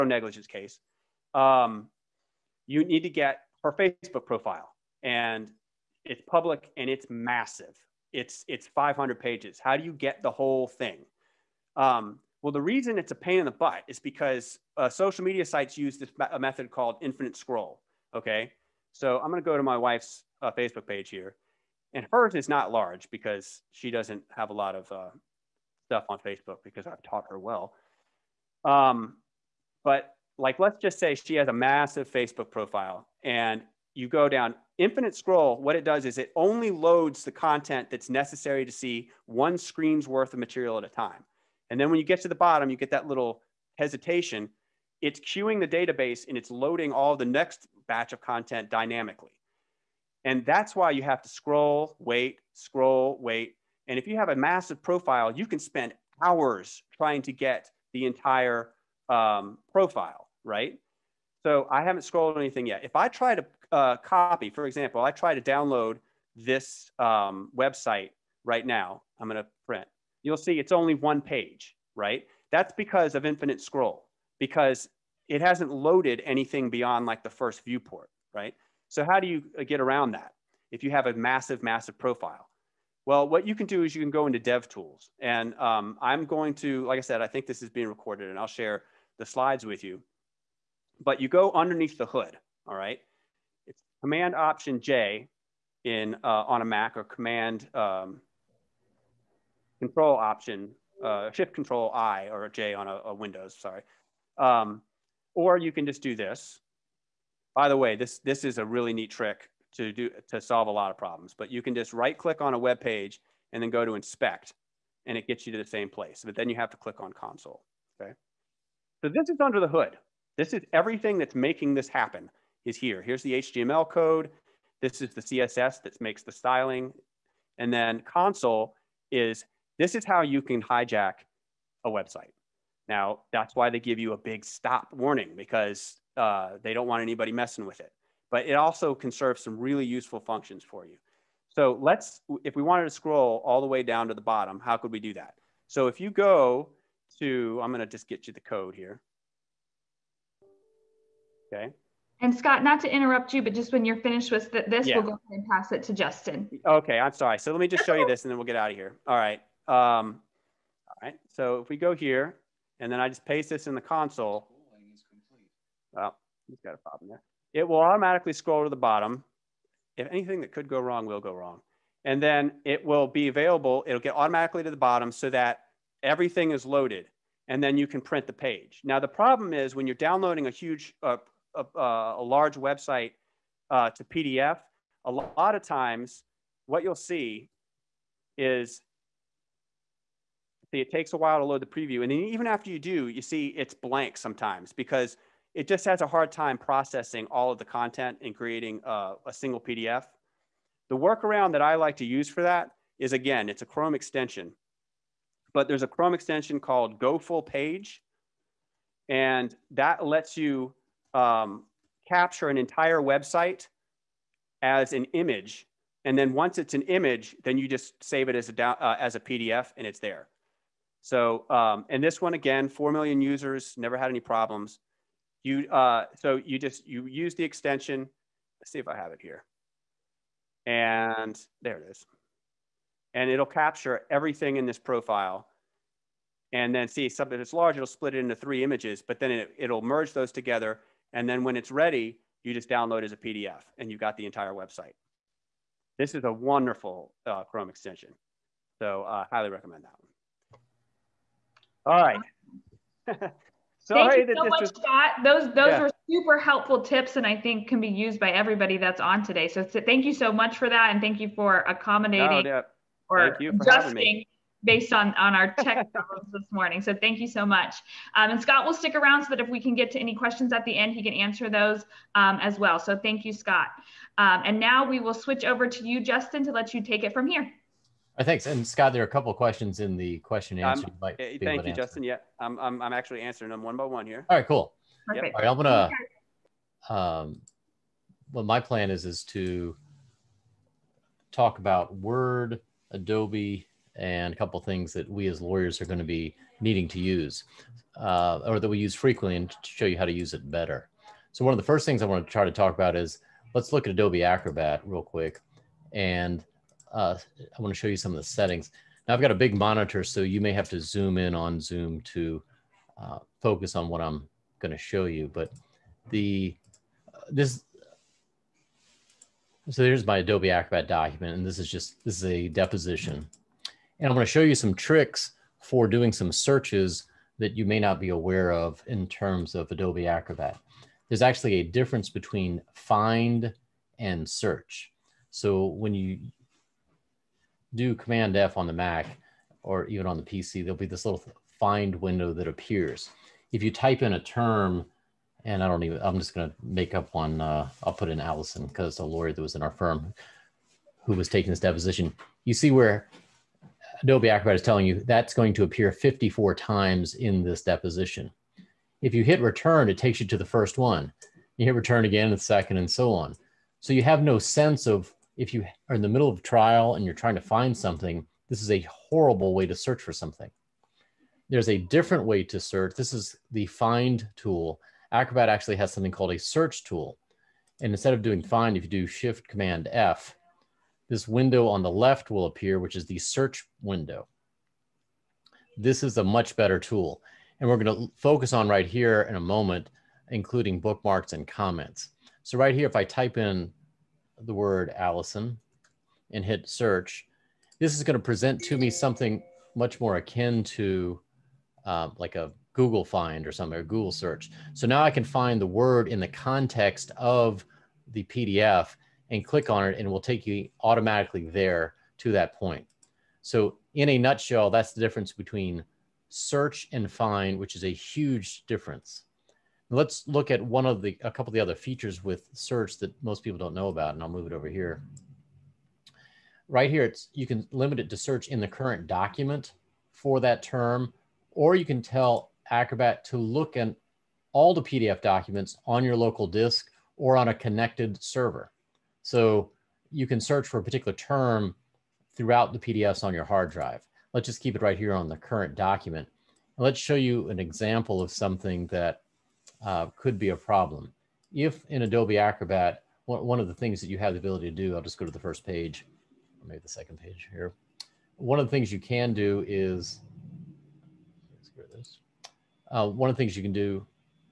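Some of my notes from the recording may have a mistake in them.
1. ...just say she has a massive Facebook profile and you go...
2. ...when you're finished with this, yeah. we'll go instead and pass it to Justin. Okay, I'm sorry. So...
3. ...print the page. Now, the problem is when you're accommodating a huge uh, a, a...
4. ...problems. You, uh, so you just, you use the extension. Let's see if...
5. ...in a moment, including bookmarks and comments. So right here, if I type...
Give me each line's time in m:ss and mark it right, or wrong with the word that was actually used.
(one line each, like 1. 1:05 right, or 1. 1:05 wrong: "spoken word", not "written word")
1. 0:30 right
2. 2:33 wrong: "ahead", not "instead"
3. 2:58 wrong: "downloading", not "accommodating"
4. 3:44 right
5. 6:29 right.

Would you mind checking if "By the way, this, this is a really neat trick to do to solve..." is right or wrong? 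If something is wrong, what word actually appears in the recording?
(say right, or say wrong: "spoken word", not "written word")
right.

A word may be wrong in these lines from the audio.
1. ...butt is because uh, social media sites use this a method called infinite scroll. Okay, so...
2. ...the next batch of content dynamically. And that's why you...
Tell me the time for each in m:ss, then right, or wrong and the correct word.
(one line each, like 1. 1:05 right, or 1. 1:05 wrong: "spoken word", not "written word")
1. 0:13 right
2. 0:47 right.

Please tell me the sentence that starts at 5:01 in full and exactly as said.
So one of the first things I want to try to talk about is let's look at Adobe Acrobat real quick.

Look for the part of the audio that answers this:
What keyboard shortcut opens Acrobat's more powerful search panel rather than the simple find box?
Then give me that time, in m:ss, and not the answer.
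6:19.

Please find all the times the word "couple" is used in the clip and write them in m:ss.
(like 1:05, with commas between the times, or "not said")
4:39, 4:54, 7:01.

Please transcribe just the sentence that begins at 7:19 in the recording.
So you can search for a particular term throughout the PDFs on your hard drive.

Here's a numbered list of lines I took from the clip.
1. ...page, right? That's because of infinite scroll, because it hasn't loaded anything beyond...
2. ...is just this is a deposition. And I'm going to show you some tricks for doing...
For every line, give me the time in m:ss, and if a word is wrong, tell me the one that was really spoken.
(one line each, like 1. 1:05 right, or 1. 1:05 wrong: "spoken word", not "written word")
1. 1:11 right
2. 5:21 right.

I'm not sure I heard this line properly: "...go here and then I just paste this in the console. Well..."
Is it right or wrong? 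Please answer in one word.
right.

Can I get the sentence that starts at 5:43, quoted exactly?
If you type in a term, and I don't even, I'm just going to make up one.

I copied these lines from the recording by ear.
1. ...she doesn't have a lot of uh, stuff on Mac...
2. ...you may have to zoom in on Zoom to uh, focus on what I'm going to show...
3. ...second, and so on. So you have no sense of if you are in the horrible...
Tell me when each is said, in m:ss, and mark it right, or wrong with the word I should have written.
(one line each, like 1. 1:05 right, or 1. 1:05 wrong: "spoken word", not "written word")
1. 0:23 wrong: "Facebook", not "Mac"
2. 5:10 right
3. 6:02 wrong: "middle", not "horrible".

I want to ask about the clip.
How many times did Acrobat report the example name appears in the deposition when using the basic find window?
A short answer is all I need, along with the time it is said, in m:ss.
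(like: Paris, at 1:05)
54, at 5:55.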